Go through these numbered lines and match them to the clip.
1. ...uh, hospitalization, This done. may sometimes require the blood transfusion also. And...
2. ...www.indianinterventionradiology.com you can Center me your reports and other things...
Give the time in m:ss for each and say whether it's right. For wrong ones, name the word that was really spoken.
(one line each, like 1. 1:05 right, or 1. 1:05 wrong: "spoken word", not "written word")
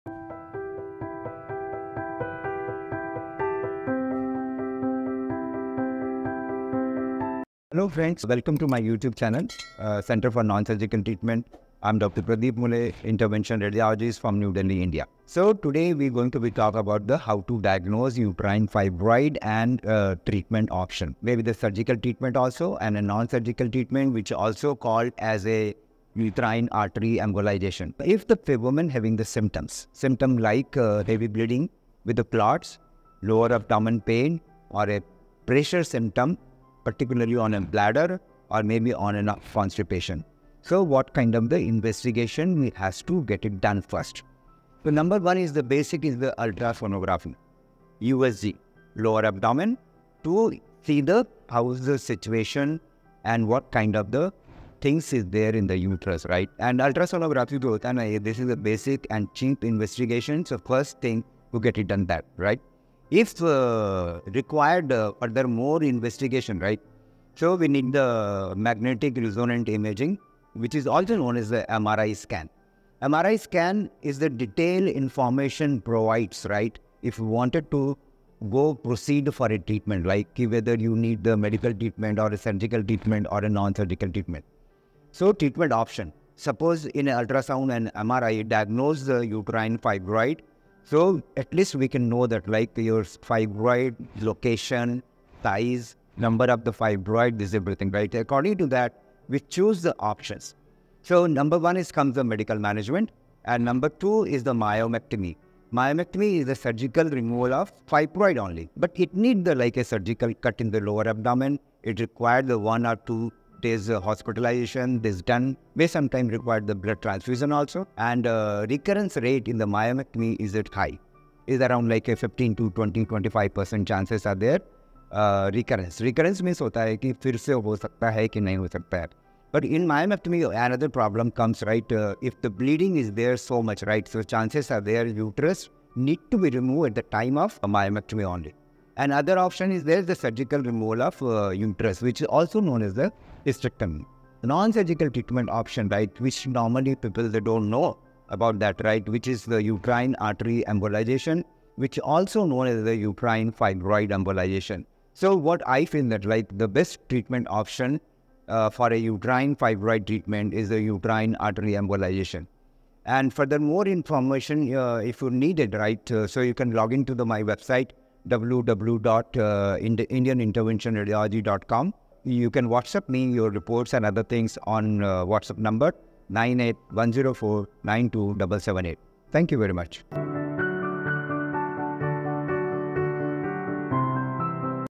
1. 1:53 right
2. 2:48 wrong: "WhatsApp", not "Center".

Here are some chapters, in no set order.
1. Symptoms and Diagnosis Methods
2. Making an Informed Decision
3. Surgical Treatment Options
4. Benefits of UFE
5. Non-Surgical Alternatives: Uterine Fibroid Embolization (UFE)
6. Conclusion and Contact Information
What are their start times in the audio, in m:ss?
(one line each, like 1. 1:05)
1. 0:35
2. 2:30
3. 1:00
4. 2:00
5. 1:30
6. 2:50.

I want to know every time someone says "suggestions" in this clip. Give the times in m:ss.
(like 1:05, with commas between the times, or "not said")
not said.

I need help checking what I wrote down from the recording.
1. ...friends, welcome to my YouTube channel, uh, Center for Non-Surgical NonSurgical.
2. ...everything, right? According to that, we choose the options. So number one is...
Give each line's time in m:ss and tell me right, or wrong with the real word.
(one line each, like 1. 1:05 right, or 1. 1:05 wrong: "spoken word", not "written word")
1. 0:07 wrong: "Treatment", not "NonSurgical"
2. 1:37 right.